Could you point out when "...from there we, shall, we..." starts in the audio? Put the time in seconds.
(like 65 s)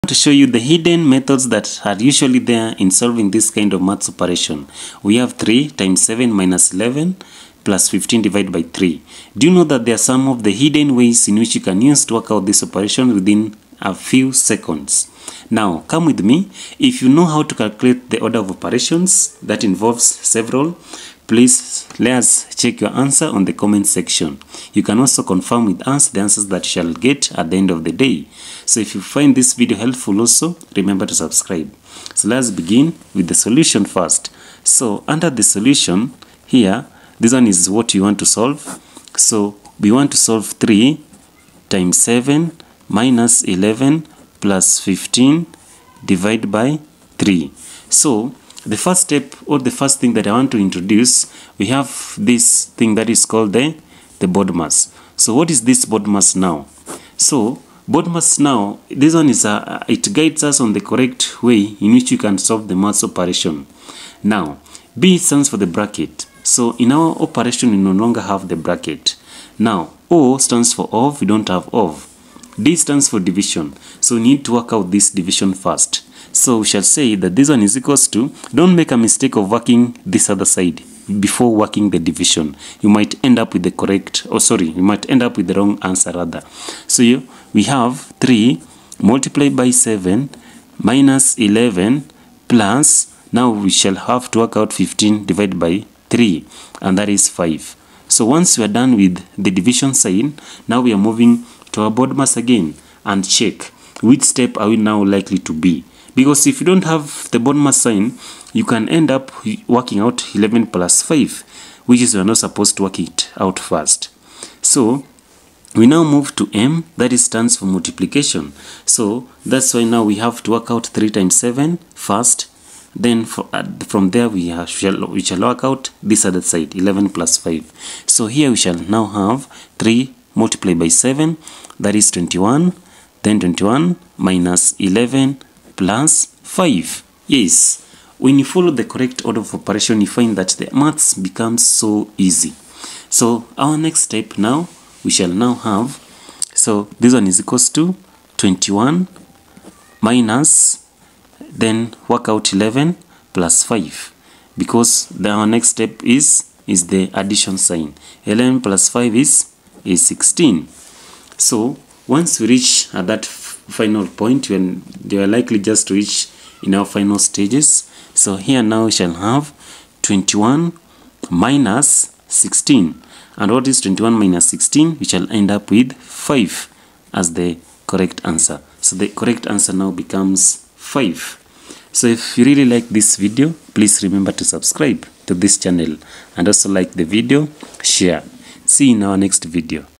123 s.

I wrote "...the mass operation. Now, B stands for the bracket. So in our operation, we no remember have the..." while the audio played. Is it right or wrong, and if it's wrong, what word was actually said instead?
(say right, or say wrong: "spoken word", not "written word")
wrong: "longer", not "remember".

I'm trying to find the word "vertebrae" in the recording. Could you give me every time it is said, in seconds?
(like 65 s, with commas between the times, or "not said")
not said.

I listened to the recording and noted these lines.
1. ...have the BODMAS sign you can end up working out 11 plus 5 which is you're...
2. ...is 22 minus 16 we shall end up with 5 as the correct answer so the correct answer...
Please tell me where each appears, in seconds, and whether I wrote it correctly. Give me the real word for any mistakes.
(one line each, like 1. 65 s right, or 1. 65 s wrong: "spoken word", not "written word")
1. 106 s right
2. 173 s wrong: "21", not "22".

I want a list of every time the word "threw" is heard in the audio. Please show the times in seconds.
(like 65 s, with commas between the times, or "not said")
not said.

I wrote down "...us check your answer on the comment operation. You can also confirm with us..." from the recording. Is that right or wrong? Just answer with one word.
wrong.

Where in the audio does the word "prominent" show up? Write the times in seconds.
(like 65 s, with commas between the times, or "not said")
not said.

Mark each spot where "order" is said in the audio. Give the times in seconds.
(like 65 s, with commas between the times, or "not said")
18 s, 139 s.